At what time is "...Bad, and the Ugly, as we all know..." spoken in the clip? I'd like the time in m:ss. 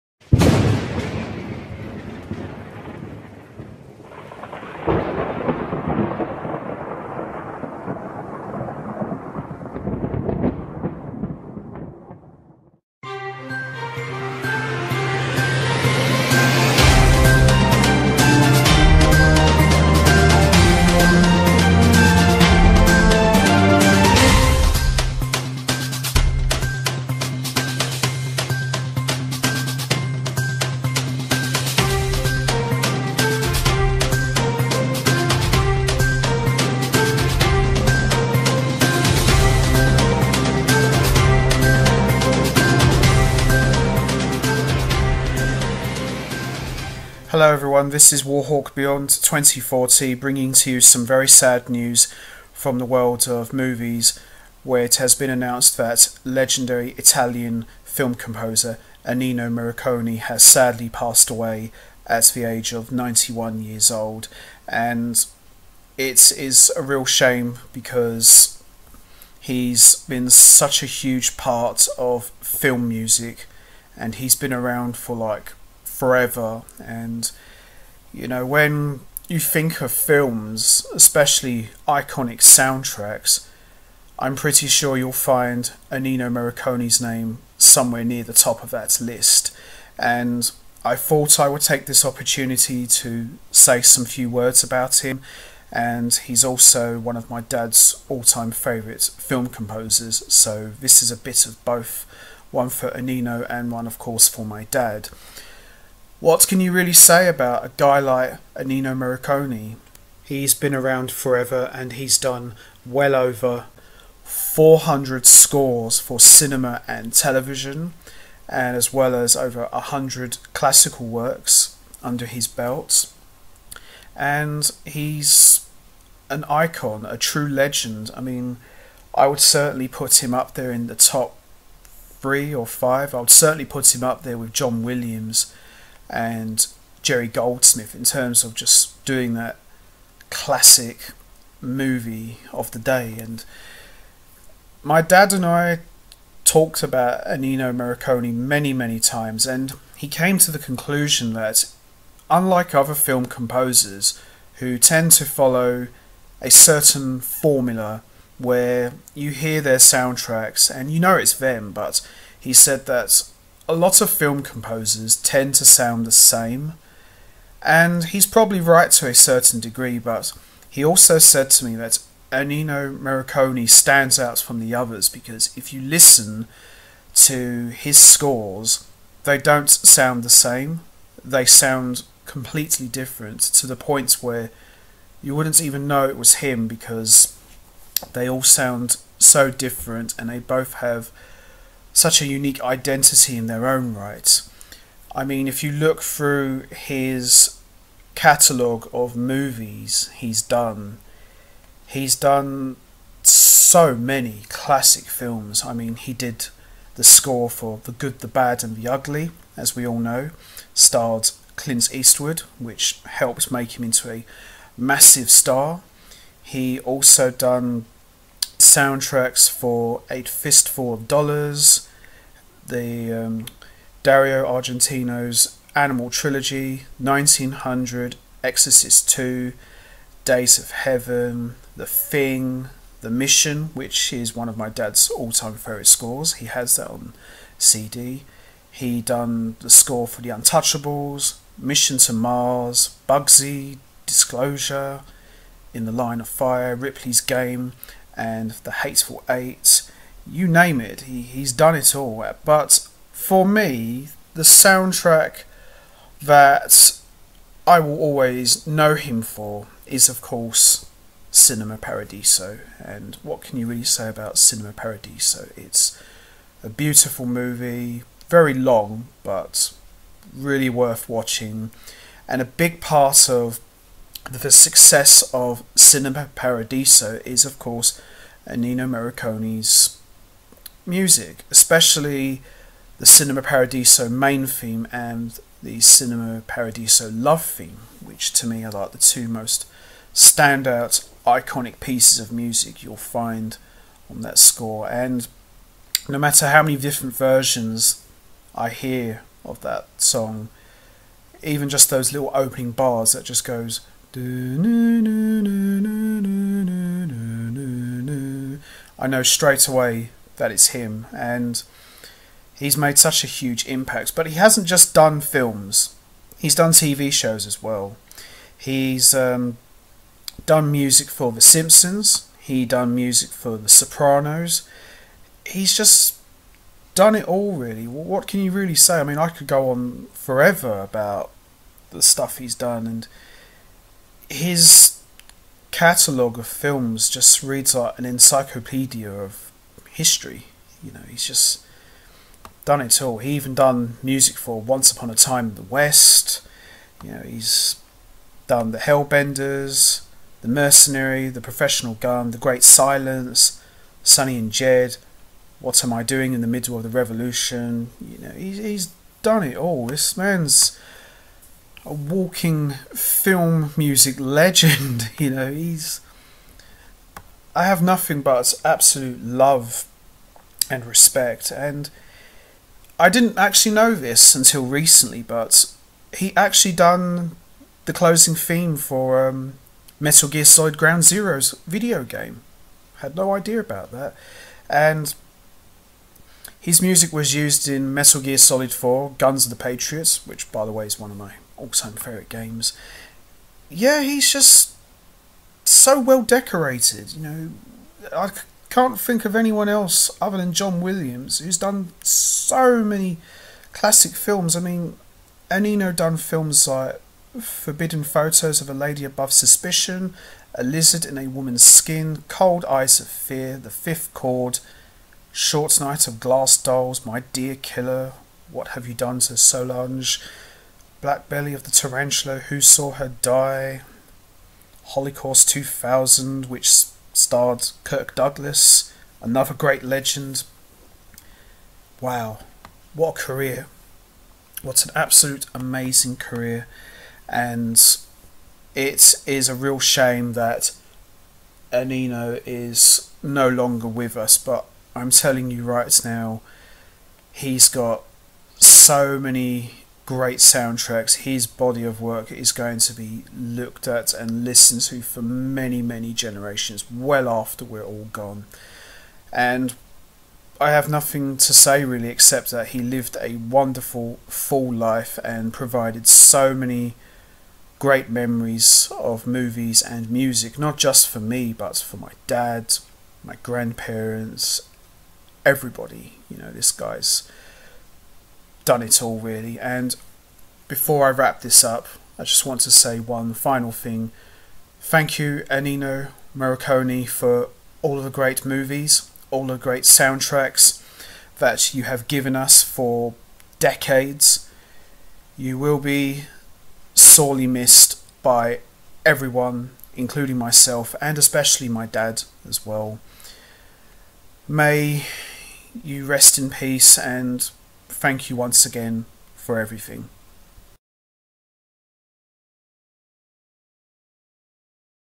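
3:28.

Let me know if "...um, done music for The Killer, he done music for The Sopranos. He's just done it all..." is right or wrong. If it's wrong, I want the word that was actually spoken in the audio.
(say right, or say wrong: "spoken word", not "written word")
wrong: "Simpsons", not "Killer".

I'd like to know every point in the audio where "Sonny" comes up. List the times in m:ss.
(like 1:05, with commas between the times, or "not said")
5:54.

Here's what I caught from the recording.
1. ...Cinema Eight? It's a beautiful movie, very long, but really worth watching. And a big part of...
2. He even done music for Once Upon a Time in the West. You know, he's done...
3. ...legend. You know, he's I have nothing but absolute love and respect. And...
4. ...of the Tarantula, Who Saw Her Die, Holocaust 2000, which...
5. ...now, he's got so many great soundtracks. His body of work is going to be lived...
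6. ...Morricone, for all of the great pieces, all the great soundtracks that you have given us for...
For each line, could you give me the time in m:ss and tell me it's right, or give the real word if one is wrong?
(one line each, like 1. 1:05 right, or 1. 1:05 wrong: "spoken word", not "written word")
1. 4:24 wrong: "Paradiso", not "Eight"
2. 5:43 right
3. 6:04 right
4. 7:01 right
5. 7:26 wrong: "looked", not "lived"
6. 8:06 wrong: "movies", not "pieces".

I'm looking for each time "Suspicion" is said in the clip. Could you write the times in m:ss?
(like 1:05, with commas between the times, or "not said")
6:49.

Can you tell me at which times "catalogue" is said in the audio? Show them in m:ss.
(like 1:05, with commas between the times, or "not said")
3:18, 5:35.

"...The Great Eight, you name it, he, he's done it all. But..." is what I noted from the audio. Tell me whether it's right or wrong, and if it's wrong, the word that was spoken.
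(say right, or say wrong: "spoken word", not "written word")
wrong: "Hateful", not "Great".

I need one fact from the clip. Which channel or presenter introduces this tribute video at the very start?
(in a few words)
Warhawk Beyond 2040.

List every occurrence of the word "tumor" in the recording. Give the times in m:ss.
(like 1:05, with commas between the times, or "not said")
not said.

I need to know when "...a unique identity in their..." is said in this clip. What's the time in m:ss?
3:12.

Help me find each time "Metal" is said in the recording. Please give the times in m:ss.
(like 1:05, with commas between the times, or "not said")
6:19, 6:27.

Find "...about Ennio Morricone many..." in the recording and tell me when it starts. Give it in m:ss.
2:26.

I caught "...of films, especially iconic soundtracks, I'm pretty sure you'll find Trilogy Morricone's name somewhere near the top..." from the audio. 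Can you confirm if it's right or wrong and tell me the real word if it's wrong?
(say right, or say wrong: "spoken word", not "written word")
wrong: "Ennio", not "Trilogy".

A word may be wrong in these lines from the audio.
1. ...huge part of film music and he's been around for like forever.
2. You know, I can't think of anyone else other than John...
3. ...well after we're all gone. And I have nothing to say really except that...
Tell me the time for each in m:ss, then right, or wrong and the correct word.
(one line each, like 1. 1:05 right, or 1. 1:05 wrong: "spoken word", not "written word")
1. 1:11 right
2. 6:37 right
3. 7:36 right.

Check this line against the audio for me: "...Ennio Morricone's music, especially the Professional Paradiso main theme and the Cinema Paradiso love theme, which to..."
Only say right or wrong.
wrong.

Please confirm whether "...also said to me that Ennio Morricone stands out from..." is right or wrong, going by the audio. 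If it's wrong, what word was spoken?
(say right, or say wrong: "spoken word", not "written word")
right.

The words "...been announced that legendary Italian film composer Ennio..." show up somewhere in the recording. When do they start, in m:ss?
0:55.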